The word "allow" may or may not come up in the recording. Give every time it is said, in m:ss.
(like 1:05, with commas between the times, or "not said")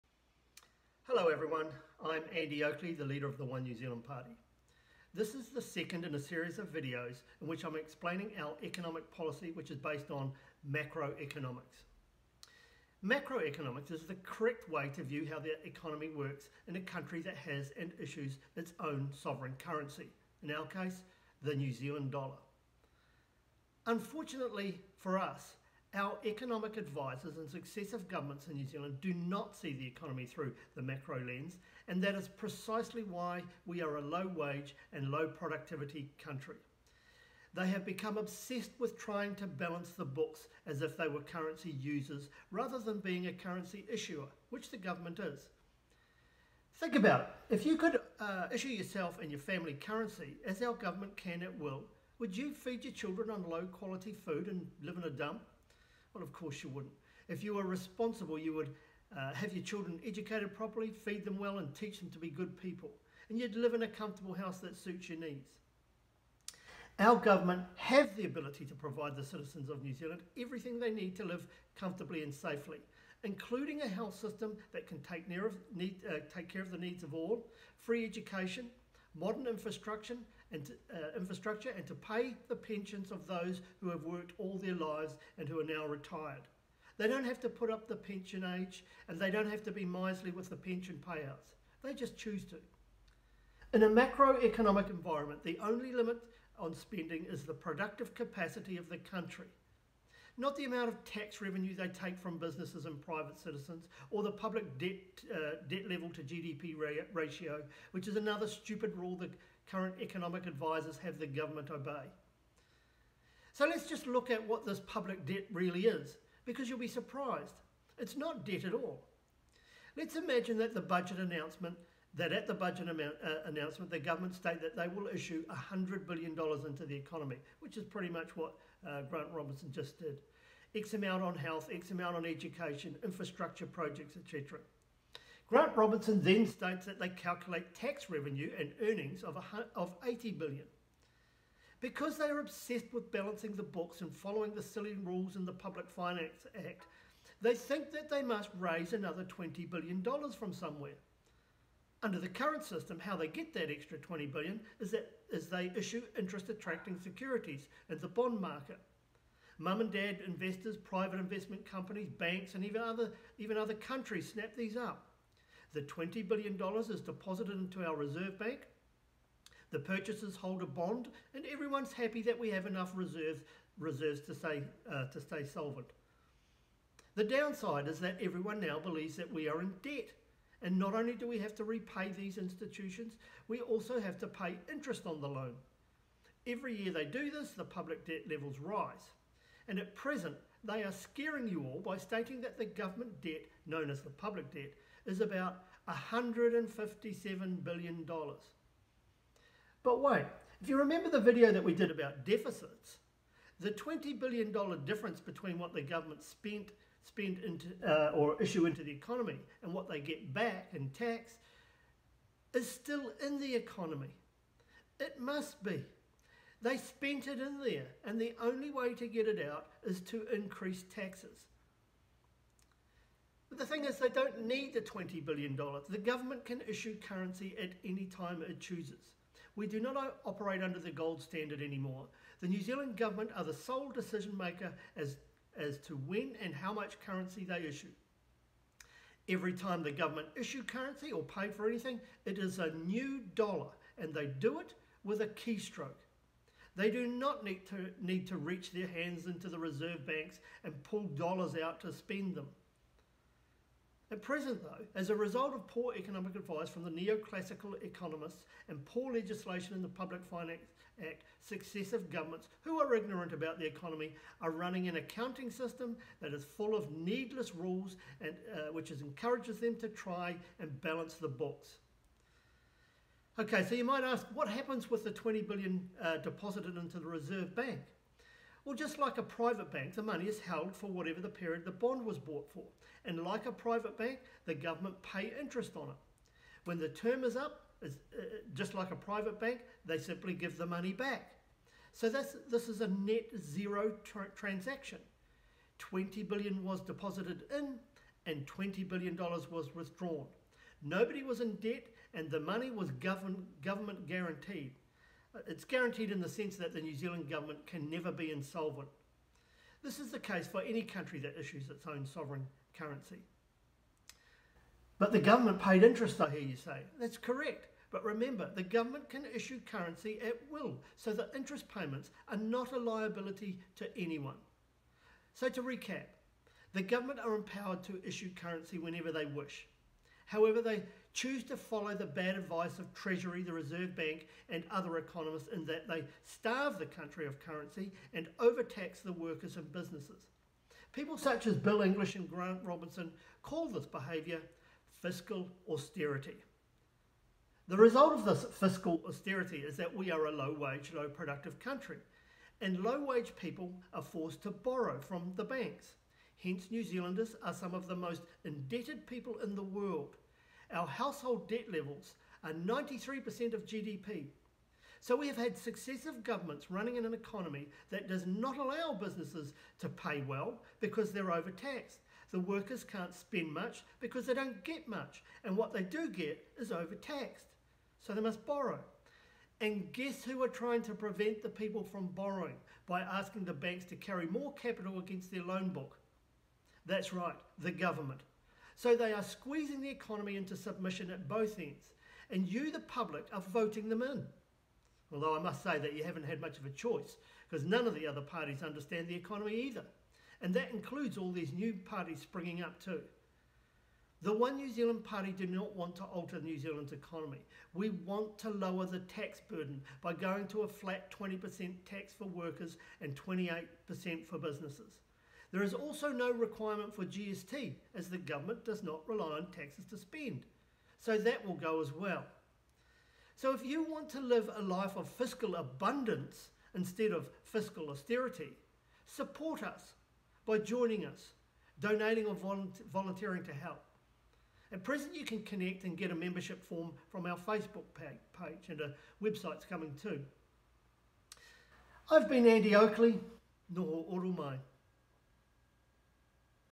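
6:08.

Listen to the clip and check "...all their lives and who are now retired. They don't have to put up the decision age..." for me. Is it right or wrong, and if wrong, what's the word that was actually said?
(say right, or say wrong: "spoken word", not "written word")
wrong: "pension", not "decision".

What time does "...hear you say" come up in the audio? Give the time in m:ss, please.
5:16.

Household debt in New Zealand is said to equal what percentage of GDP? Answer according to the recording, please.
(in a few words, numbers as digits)
93%.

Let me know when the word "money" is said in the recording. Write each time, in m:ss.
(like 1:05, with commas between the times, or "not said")
4:40, 4:50, 5:02.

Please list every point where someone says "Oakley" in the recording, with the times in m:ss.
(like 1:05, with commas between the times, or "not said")
0:02, 7:22.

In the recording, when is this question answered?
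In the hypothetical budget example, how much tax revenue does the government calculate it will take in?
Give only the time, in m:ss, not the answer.
2:20.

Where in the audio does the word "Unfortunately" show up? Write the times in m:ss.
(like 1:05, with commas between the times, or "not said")
0:23.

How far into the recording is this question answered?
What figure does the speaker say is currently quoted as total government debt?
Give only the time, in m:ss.
3:15.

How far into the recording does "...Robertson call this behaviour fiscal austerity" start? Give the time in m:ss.
5:42.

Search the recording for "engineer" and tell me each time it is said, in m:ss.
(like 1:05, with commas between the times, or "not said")
not said.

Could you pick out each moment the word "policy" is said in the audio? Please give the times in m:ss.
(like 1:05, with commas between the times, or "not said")
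0:09.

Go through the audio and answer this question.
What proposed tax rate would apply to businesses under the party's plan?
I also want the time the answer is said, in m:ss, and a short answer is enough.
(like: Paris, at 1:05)
28%, at 6:53.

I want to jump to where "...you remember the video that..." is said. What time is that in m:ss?
3:20.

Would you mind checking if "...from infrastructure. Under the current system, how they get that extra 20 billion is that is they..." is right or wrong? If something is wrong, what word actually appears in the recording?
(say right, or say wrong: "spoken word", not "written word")
wrong: "somewhere", not "infrastructure".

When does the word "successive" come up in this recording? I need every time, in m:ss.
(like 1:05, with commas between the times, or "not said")
0:27, 4:21, 6:05.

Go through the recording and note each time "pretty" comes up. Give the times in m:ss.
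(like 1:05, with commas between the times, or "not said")
2:07.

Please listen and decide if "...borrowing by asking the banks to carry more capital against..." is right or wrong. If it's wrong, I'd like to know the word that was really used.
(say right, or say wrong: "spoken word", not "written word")
right.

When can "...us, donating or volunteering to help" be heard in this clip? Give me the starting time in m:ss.
7:11.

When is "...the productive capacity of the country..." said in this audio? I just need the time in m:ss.
1:37.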